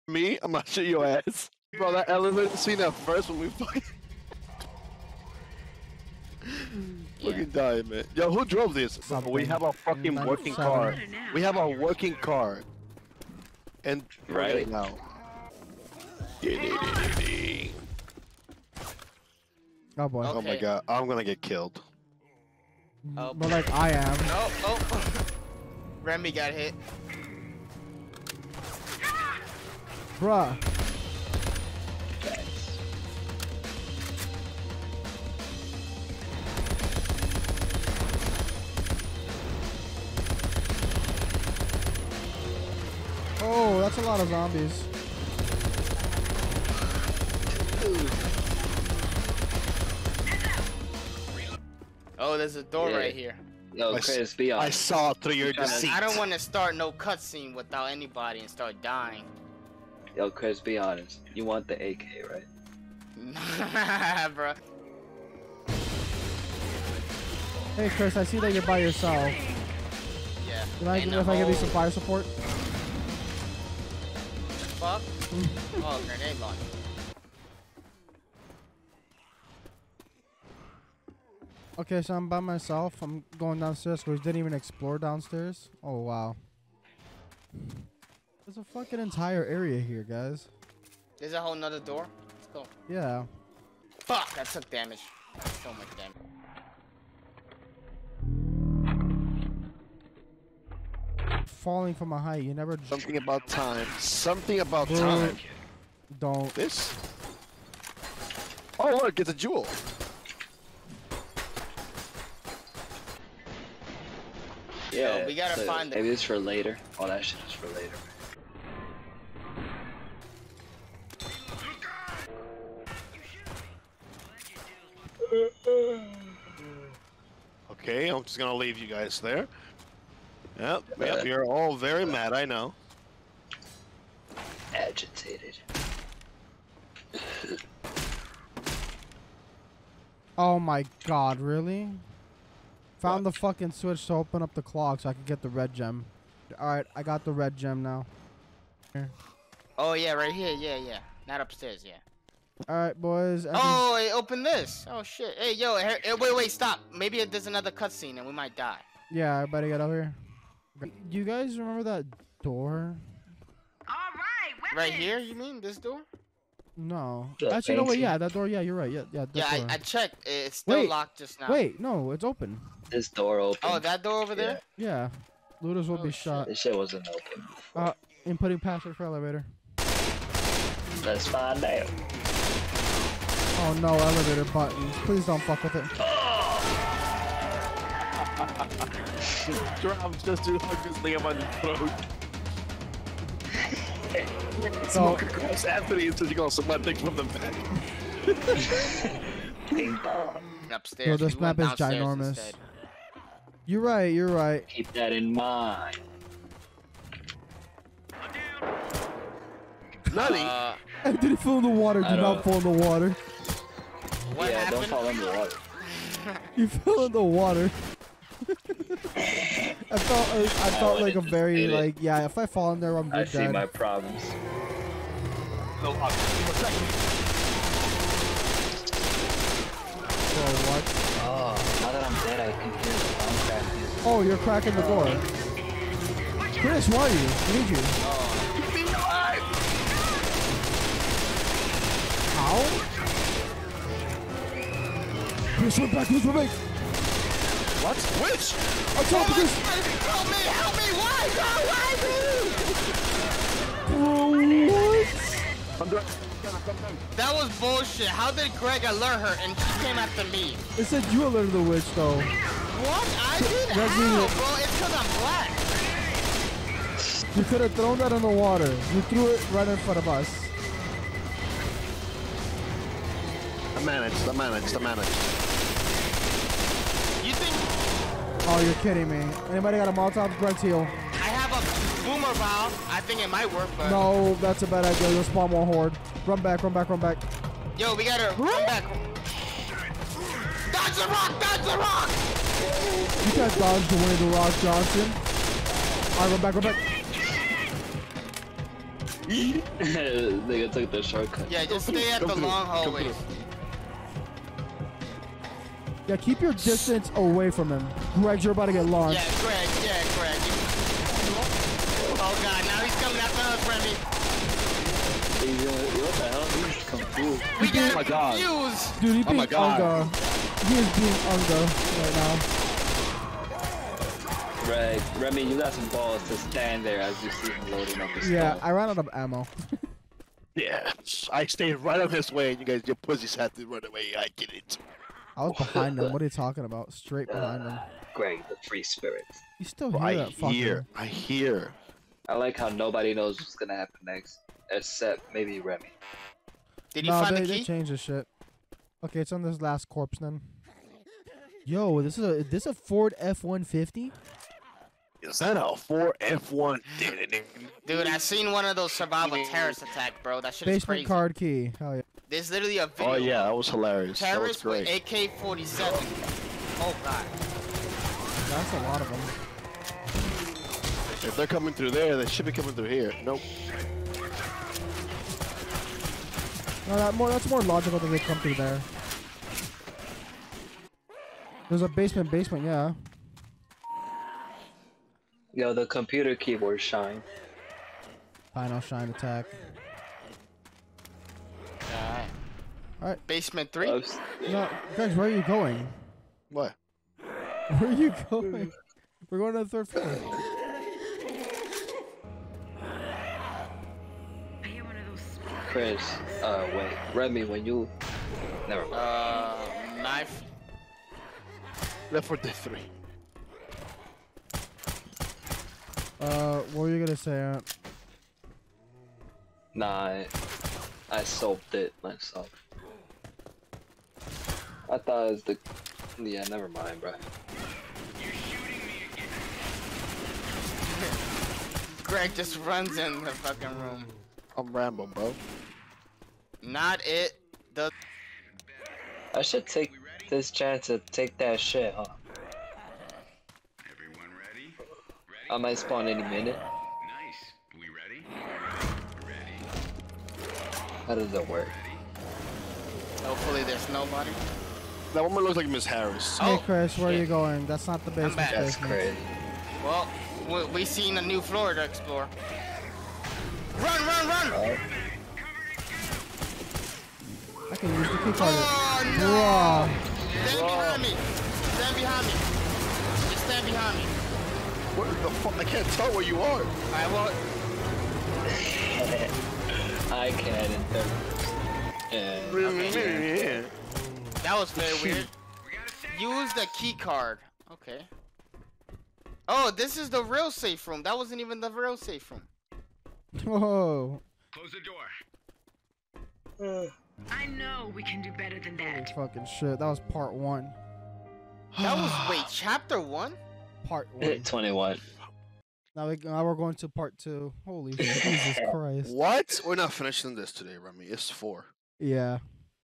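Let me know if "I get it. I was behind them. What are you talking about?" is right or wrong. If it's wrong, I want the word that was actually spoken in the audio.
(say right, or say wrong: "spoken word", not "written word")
right.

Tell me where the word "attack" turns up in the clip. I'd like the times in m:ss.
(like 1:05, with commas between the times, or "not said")
5:59, 6:29.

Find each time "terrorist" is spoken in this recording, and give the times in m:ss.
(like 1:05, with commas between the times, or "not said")
5:59, 6:04.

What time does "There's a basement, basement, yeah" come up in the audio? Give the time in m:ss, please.
6:21.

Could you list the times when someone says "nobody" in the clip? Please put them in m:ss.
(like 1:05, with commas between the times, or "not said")
5:42, 7:33.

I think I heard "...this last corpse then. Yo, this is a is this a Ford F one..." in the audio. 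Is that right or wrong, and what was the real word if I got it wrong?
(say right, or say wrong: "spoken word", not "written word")
right.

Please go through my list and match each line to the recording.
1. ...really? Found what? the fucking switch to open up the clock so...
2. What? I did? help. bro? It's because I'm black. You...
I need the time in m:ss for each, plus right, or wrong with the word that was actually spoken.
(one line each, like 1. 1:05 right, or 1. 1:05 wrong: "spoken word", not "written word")
1. 2:21 right
2. 4:22 right.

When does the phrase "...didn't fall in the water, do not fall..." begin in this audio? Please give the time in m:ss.
3:31.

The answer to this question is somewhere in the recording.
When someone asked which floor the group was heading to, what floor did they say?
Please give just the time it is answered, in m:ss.
6:39.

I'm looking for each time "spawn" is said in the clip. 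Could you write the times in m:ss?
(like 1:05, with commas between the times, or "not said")
4:45, 7:25.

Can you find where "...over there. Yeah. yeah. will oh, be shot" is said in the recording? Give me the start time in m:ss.
2:54.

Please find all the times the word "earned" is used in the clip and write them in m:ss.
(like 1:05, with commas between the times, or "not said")
not said.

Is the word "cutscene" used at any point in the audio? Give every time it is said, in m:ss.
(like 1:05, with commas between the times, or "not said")
0:56, 2:37.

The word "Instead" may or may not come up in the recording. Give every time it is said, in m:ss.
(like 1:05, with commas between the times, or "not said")
3:22.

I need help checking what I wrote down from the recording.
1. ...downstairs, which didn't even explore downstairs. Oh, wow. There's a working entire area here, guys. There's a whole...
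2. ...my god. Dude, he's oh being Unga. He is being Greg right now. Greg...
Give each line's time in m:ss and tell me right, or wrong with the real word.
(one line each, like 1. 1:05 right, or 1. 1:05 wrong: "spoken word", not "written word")
1. 1:23 wrong: "fucking", not "working"
2. 5:17 wrong: "Unga", not "Greg".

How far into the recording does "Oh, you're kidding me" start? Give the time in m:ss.
4:38.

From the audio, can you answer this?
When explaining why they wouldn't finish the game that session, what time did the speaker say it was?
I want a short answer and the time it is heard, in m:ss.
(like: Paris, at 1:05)
4, at 8:31.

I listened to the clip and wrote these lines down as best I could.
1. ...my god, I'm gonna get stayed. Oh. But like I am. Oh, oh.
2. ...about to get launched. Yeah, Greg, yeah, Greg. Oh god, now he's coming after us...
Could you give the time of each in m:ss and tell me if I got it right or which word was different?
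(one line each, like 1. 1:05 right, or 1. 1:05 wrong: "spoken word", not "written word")
1. 0:20 wrong: "killed", not "stayed"
2. 5:08 right.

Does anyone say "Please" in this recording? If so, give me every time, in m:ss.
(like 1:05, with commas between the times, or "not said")
3:05.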